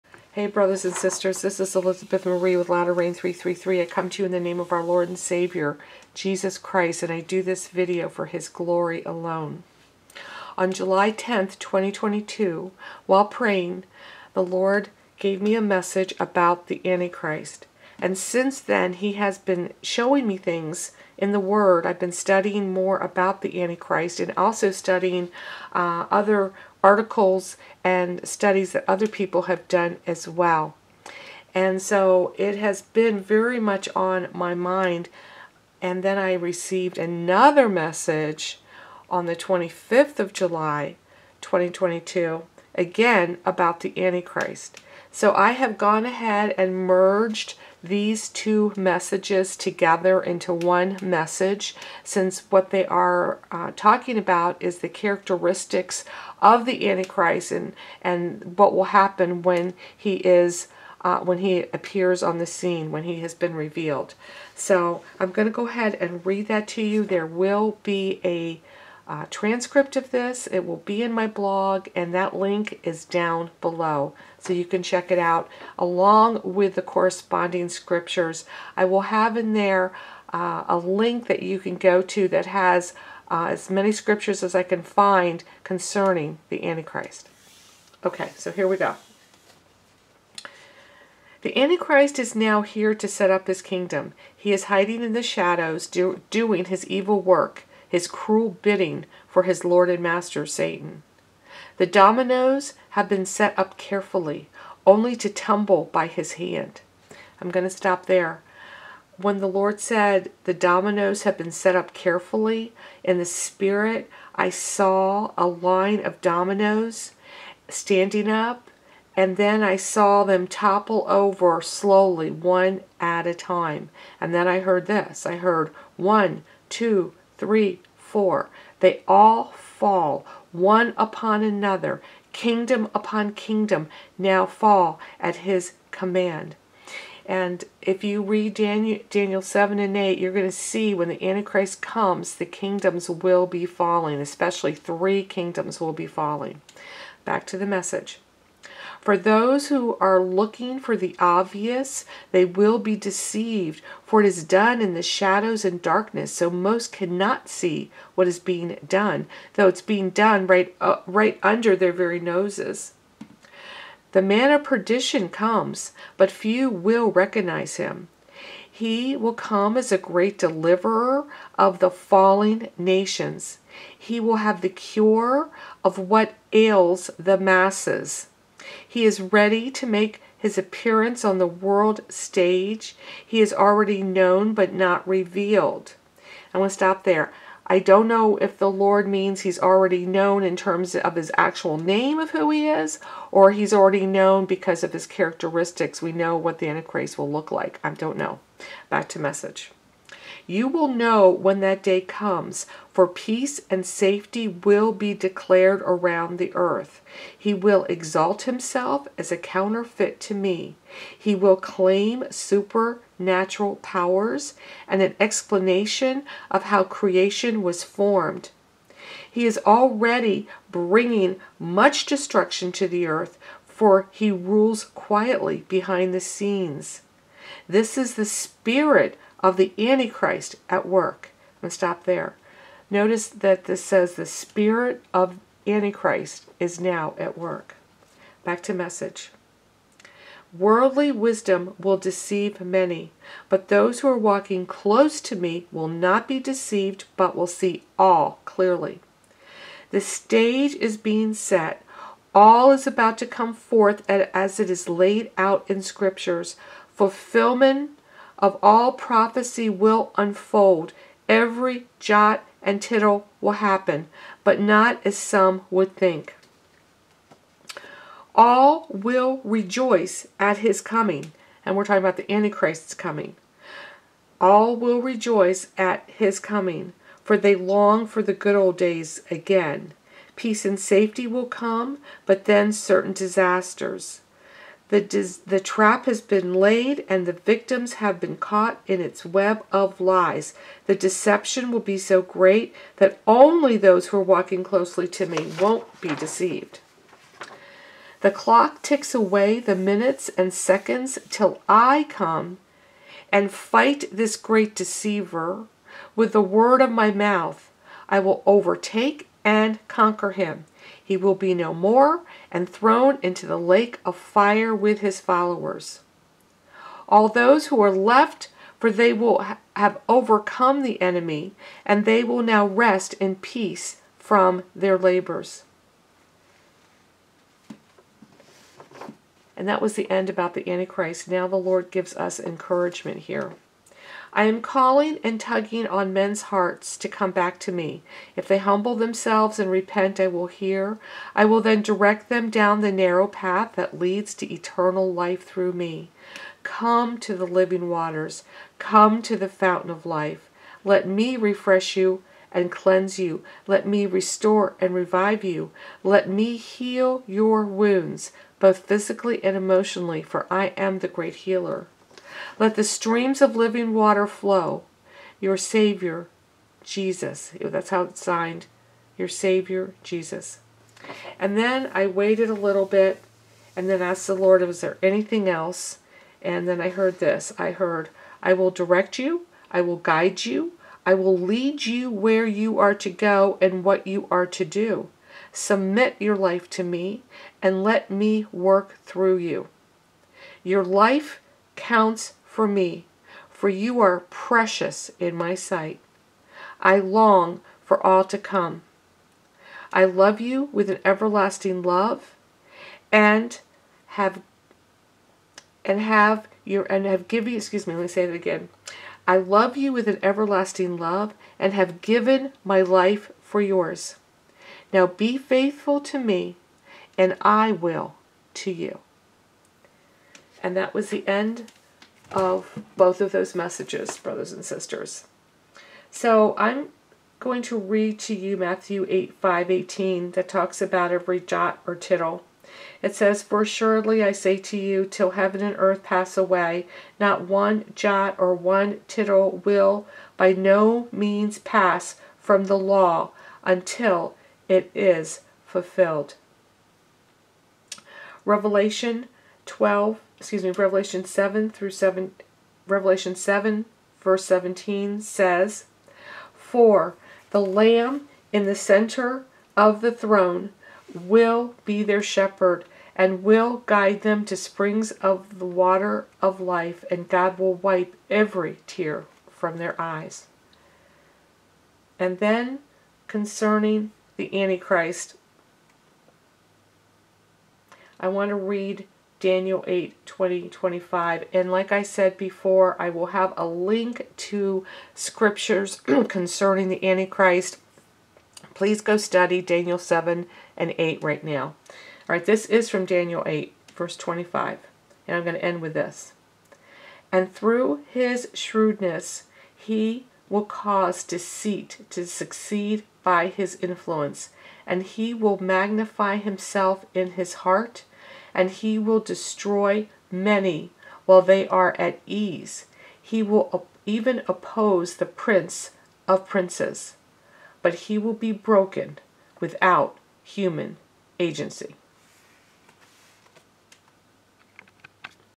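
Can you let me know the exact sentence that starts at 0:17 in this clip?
And since then, He has been showing me things in the Word.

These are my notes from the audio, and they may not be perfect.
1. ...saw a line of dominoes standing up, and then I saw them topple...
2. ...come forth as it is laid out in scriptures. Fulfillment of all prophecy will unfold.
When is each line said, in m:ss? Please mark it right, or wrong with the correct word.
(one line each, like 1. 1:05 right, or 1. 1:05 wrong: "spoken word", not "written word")
1. 1:54 right
2. 4:13 right.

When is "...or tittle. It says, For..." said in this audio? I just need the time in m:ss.
7:11.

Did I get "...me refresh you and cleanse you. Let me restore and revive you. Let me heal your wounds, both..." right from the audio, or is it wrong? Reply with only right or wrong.
right.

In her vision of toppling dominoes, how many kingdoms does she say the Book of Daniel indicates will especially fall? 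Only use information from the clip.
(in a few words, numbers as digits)
3.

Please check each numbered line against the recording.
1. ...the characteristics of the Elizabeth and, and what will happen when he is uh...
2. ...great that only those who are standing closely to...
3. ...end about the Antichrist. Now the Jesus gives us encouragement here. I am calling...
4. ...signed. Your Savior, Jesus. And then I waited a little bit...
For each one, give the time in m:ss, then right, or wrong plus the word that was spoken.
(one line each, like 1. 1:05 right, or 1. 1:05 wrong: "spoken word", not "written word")
1. 0:54 wrong: "Antichrist", not "Elizabeth"
2. 4:52 wrong: "walking", not "standing"
3. 5:30 wrong: "Lord", not "Jesus"
4. 6:08 right.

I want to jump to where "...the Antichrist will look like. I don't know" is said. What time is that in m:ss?
3:16.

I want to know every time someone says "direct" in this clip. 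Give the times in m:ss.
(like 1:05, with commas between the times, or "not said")
5:41, 6:18.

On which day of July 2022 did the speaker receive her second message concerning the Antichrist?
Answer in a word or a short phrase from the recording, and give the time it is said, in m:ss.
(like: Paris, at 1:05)
25th, at 0:39.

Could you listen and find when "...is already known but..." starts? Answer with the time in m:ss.
3:03.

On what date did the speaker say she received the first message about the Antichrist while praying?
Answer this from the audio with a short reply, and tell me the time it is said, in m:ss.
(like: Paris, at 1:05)
July 10th, 2022, at 0:10.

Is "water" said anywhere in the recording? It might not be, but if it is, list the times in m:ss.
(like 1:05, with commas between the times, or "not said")
5:47, 6:03, 7:45.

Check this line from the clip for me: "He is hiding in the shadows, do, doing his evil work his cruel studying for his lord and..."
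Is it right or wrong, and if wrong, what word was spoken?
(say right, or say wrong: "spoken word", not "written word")
wrong: "bidding", not "studying".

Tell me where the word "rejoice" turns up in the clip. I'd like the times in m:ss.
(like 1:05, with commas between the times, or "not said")
4:29, 4:34.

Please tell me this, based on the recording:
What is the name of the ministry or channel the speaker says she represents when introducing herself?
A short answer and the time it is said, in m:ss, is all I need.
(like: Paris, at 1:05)
Latter Rain 333, at 0:02.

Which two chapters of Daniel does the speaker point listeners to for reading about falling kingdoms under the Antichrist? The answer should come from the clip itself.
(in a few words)
Daniel 7 and 8.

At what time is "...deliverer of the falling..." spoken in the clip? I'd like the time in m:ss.
2:50.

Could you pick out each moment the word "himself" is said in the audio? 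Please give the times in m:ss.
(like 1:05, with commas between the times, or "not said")
3:28, 8:26.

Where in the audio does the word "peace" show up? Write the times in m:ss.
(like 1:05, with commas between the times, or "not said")
3:23, 4:40, 5:23.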